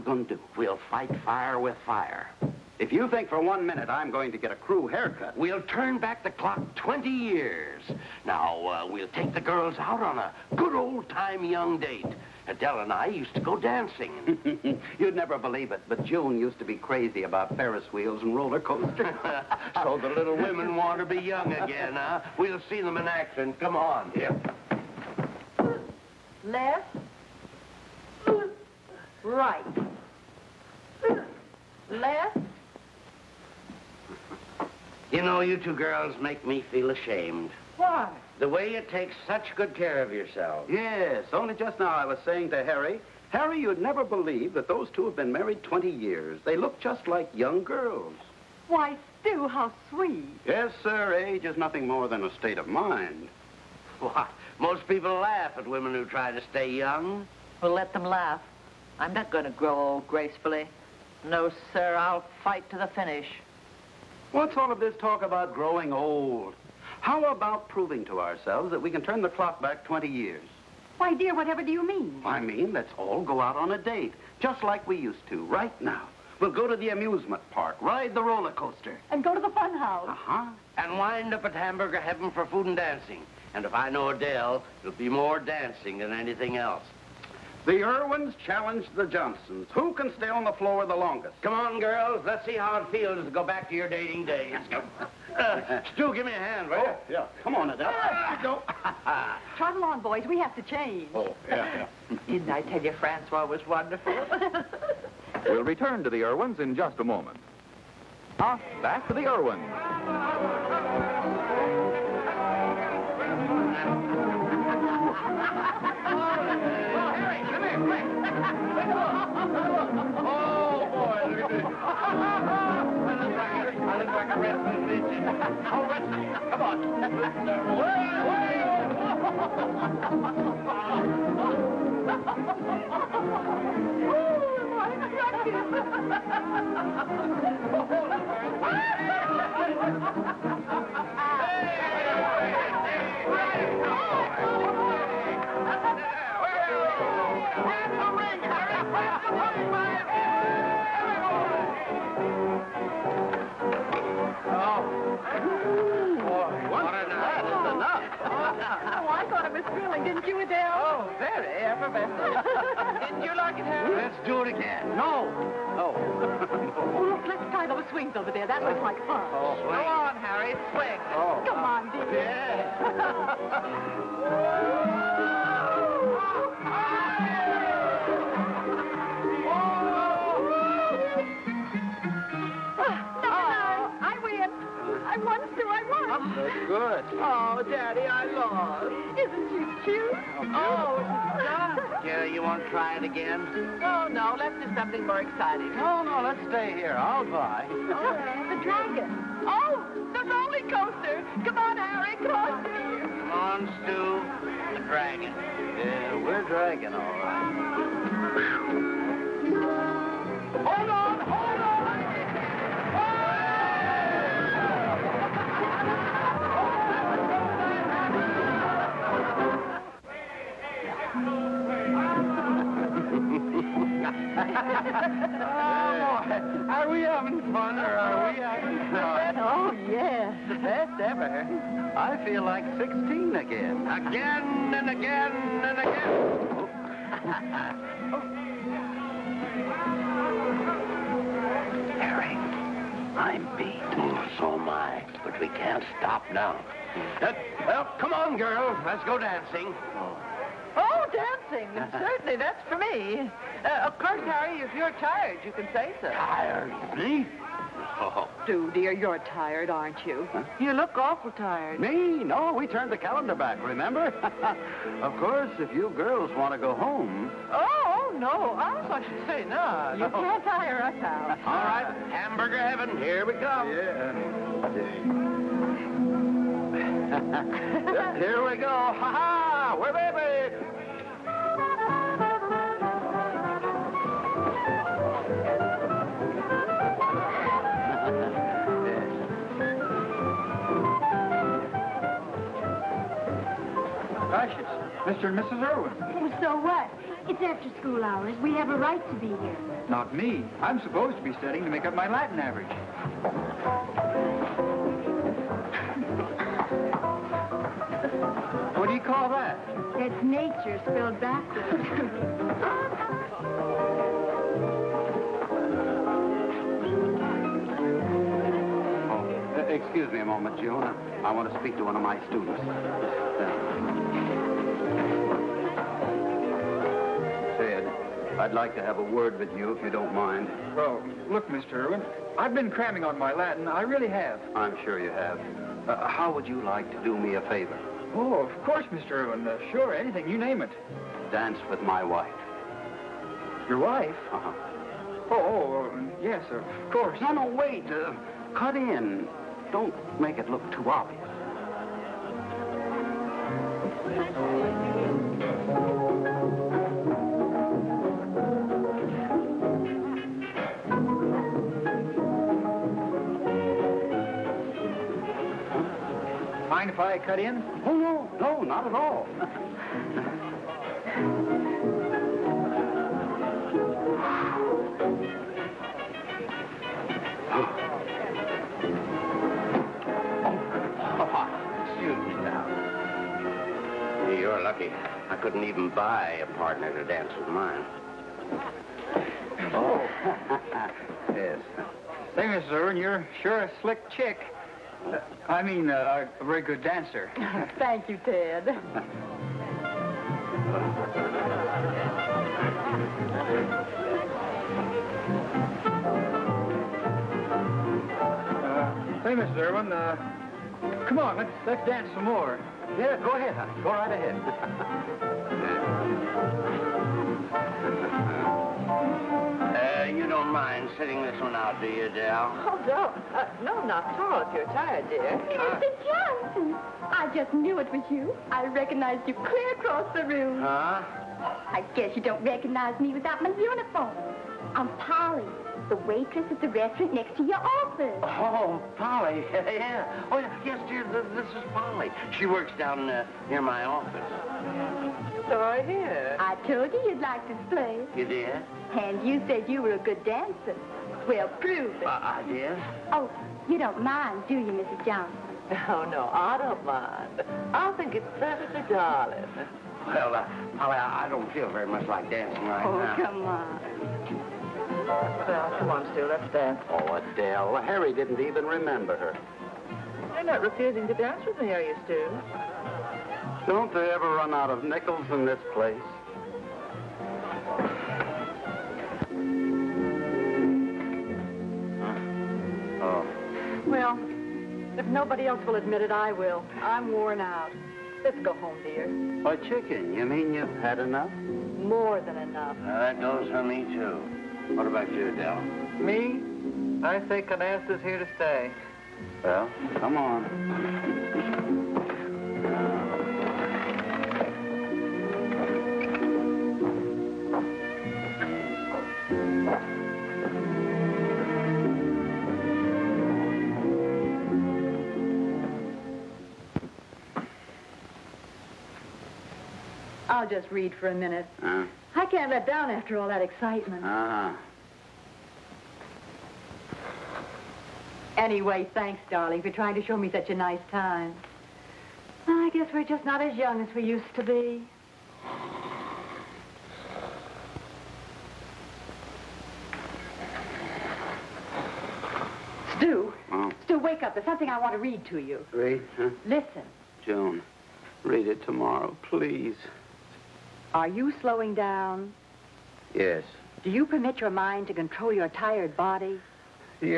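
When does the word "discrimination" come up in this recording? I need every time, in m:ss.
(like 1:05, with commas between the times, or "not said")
not said.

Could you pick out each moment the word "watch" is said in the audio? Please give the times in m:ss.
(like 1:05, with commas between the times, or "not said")
not said.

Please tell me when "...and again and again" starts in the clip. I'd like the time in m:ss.
3:54.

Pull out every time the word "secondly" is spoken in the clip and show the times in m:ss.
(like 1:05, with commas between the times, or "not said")
not said.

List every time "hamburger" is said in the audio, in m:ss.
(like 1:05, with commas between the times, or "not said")
1:21, 4:32.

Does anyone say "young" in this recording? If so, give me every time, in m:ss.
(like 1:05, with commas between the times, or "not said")
0:11, 0:21, 0:47, 0:56, 8:53.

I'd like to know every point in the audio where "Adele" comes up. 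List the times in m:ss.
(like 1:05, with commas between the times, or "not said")
0:12, 1:24, 1:37, 2:40, 7:47.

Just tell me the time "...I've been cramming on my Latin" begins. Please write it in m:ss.
5:32.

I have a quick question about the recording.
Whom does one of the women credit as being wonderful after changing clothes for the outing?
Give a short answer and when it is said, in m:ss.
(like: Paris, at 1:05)
Francois, at 1:42.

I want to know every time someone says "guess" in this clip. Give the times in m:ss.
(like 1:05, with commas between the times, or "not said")
7:11, 8:52.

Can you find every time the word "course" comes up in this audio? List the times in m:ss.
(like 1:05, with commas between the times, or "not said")
4:13, 4:25, 5:38, 5:46.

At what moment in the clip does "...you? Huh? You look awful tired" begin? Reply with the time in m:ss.
4:20.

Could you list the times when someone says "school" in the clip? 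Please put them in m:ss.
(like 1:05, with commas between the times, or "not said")
4:57.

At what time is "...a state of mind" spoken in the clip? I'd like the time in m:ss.
0:52.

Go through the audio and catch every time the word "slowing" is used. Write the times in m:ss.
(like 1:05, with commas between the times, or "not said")
9:11.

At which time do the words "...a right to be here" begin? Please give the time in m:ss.
4:58.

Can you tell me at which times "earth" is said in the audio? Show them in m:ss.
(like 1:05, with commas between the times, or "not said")
not said.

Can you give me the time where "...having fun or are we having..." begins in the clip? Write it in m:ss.
3:47.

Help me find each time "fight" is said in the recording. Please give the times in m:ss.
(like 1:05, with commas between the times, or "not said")
0:00, 1:02.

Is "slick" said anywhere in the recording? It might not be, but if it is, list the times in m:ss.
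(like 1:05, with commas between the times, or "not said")
6:33.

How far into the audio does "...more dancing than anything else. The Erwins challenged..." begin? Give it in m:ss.
1:25.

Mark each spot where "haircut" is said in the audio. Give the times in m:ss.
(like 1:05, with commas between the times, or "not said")
0:04.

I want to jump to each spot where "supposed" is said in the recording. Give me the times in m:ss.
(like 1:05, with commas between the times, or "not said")
5:00.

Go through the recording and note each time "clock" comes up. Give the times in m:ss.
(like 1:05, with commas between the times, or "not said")
0:06, 1:09.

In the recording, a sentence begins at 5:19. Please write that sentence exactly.
Oh, uh, excuse me a moment, June.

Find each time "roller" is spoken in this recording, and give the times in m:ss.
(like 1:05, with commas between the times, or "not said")
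0:18, 1:18, 3:20.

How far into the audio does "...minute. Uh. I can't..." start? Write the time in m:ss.
8:41.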